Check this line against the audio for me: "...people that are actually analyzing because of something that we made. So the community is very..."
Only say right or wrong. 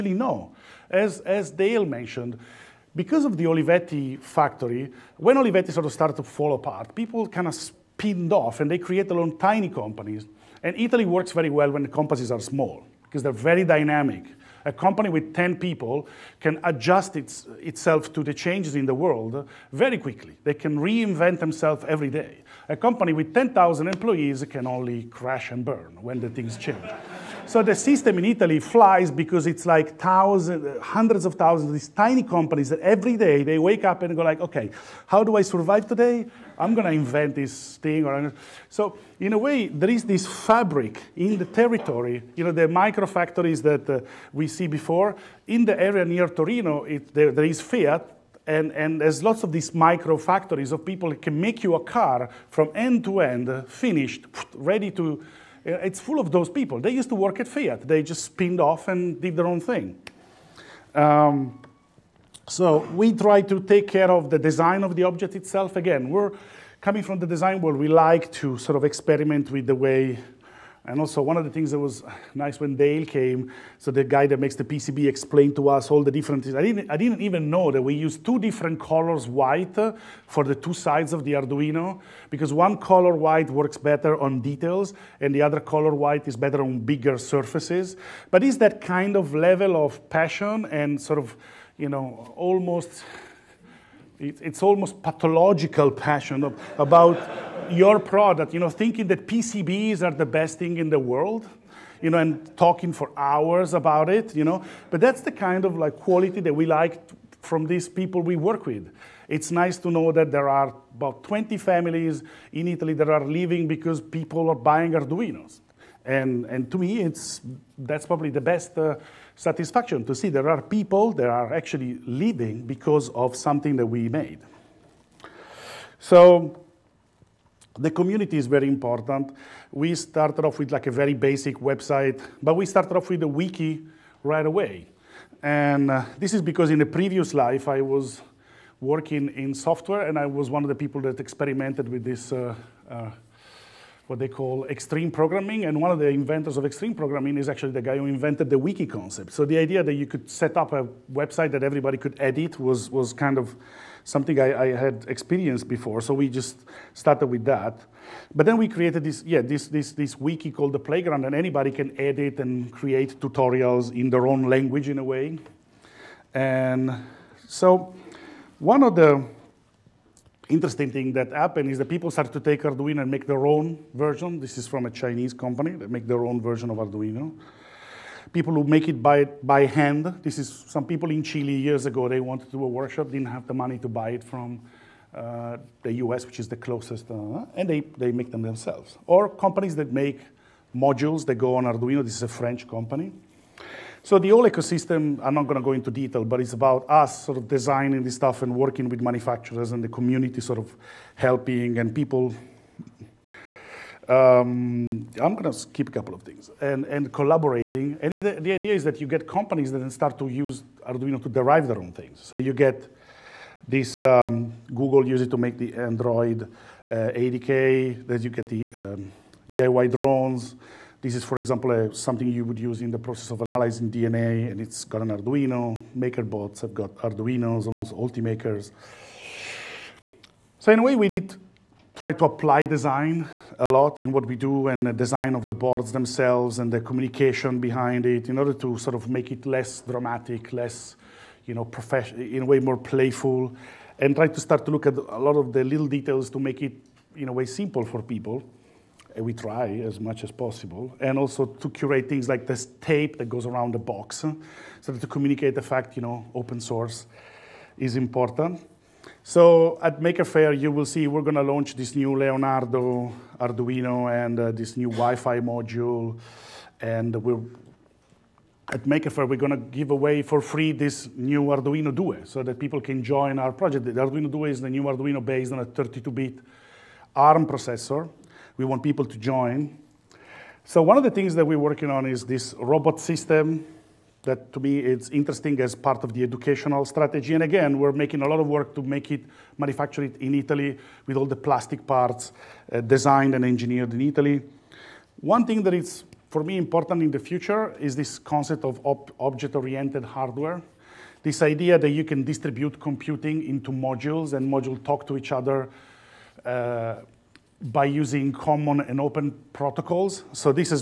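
wrong.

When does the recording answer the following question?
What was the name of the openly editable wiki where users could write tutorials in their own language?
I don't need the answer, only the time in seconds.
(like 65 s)
160 s.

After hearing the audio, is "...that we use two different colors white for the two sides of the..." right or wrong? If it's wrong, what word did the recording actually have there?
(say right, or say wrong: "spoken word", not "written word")
right.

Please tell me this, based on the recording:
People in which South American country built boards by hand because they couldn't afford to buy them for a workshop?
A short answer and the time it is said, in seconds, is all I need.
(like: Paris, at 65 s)
Chile, at 181 s.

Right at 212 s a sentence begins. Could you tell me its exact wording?
So you get this um, Google use it to make the Android uh, ADK, that you get the um, DIY drones.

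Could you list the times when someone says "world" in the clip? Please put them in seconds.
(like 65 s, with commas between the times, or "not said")
18 s, 67 s, 100 s.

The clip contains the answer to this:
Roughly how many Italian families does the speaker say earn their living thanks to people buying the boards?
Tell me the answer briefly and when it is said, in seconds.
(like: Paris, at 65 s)
20, at 111 s.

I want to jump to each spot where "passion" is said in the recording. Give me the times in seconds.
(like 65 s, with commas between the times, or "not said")
90 s, 95 s.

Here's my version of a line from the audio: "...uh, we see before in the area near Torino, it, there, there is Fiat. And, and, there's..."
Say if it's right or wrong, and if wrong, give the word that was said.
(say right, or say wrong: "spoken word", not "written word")
right.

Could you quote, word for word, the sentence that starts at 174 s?
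This is from a Chinese company that make their own version of Arduino.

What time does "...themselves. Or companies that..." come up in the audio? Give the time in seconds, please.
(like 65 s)
188 s.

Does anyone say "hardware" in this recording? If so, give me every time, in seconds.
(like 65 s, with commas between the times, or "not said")
300 s.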